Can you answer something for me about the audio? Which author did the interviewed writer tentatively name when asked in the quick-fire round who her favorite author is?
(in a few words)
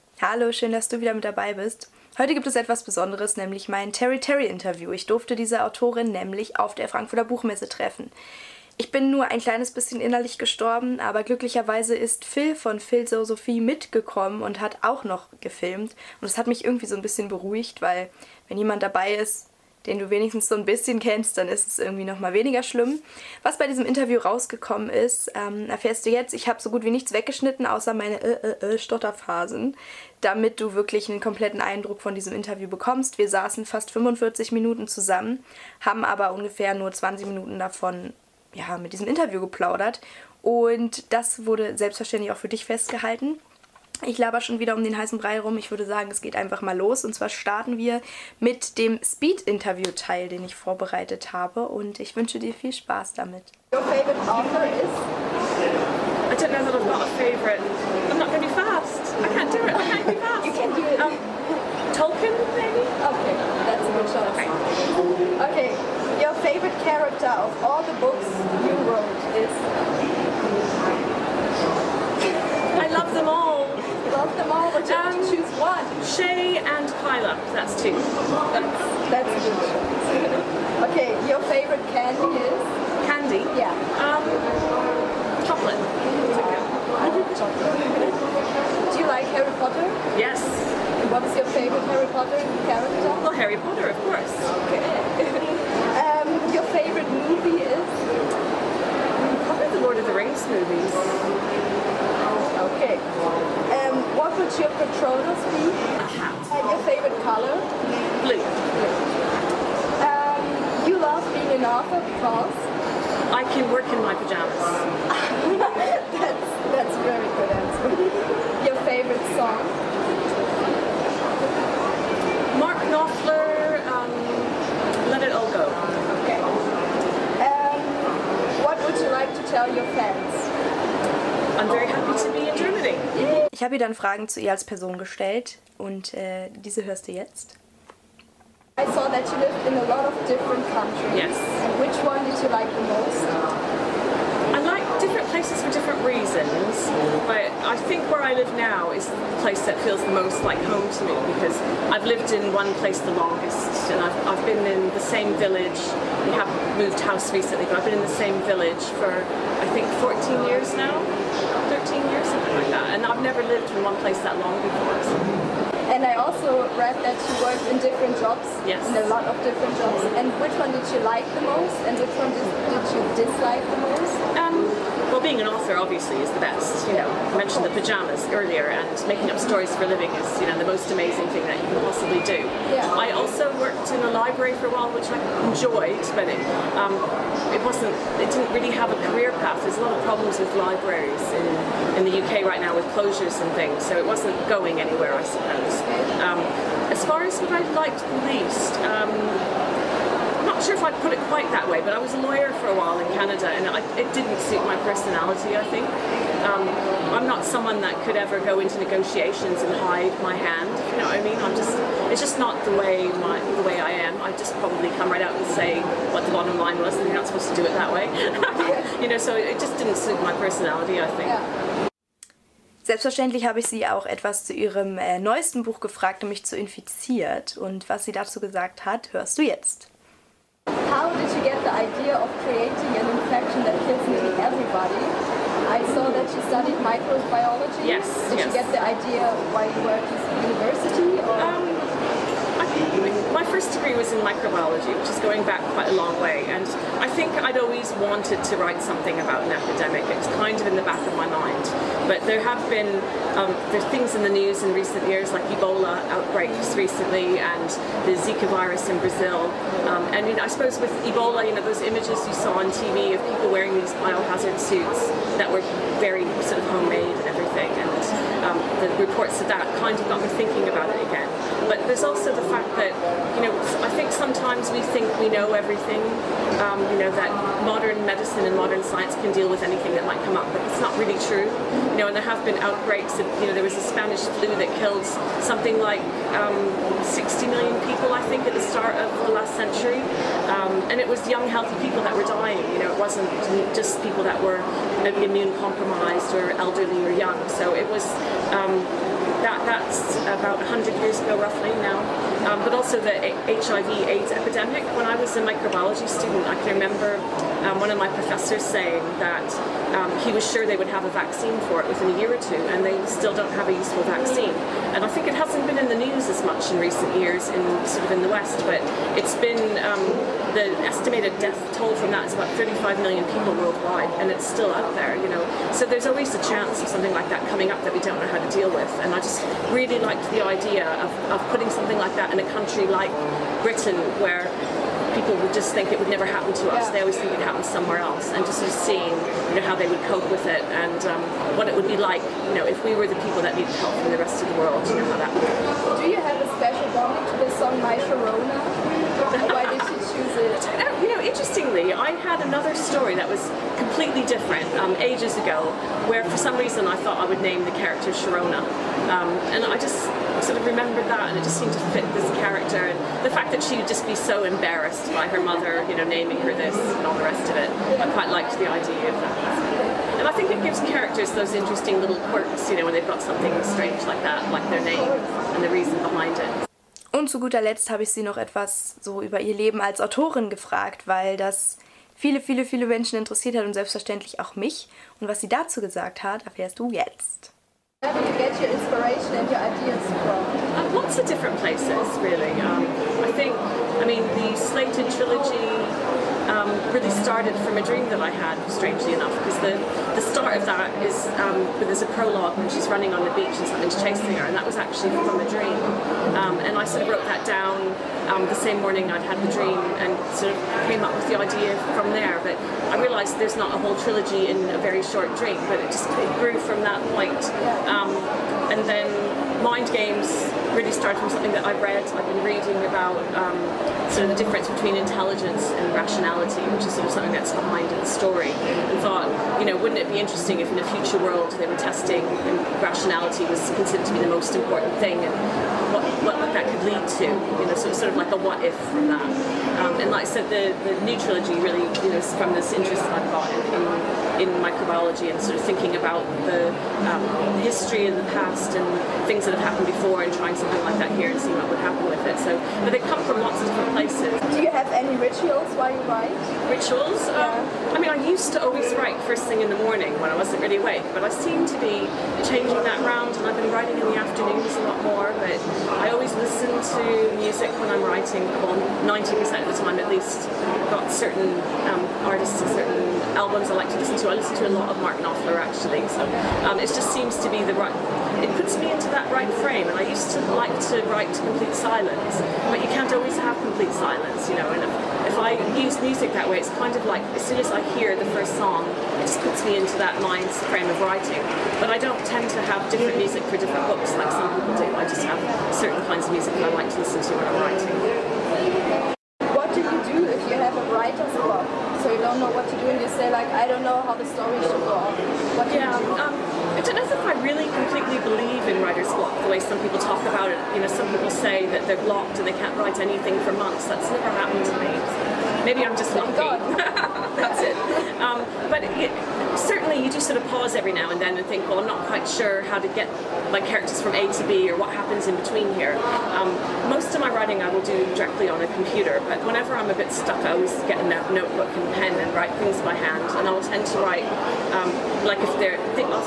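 Tolkien.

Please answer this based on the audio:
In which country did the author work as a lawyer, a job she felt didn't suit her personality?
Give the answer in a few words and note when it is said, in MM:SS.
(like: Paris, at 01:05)
Canada, at 03:23.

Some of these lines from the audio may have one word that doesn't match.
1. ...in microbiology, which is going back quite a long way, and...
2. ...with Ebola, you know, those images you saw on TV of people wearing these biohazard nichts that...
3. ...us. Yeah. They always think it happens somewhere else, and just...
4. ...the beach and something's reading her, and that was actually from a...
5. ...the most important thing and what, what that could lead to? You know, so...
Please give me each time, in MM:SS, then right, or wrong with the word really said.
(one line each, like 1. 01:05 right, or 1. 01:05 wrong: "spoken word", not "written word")
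1. 04:04 right
2. 04:20 wrong: "suits", not "nichts"
3. 05:36 right
4. 06:43 wrong: "chasing", not "reading"
5. 07:14 right.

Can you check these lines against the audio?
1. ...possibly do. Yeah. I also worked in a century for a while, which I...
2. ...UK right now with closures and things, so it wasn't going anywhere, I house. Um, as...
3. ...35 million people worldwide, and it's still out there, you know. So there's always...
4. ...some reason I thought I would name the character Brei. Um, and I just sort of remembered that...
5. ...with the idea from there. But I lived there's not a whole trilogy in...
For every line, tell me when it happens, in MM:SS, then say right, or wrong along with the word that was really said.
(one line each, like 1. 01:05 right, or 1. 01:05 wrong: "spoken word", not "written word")
1. 03:01 wrong: "library", not "century"
2. 03:12 wrong: "suppose", not "house"
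3. 05:22 right
4. 05:56 wrong: "Sharona", not "Brei"
5. 06:51 wrong: "realised", not "lived".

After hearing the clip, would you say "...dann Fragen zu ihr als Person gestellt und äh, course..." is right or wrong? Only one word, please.
wrong.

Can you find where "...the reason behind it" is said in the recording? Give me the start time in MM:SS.
06:15.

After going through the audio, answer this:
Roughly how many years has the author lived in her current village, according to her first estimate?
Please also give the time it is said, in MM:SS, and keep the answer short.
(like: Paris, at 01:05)
14 years, at 02:40.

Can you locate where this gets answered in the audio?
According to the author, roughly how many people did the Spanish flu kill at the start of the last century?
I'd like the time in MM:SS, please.
04:47.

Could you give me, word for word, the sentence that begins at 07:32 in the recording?
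So, but they come from lots of different places.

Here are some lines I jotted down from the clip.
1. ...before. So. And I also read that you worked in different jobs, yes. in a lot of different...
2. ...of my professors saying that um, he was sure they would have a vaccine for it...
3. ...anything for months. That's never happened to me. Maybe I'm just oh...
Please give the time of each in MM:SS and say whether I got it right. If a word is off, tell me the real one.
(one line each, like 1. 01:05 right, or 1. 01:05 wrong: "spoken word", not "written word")
1. 02:44 right
2. 05:07 right
3. 08:32 right.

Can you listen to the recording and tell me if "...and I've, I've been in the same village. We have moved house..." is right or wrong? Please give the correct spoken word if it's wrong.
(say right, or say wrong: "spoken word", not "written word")
right.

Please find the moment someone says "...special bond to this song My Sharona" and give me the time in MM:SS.
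05:46.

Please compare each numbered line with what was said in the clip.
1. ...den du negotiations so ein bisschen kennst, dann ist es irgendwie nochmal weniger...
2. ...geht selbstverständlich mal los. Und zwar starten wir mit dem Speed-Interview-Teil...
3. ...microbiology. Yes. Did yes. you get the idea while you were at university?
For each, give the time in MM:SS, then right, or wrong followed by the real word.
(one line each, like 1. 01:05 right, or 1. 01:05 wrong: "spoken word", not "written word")
1. 00:19 wrong: "wenigstens", not "negotiations"
2. 00:46 wrong: "einfach", not "selbstverständlich"
3. 03:56 right.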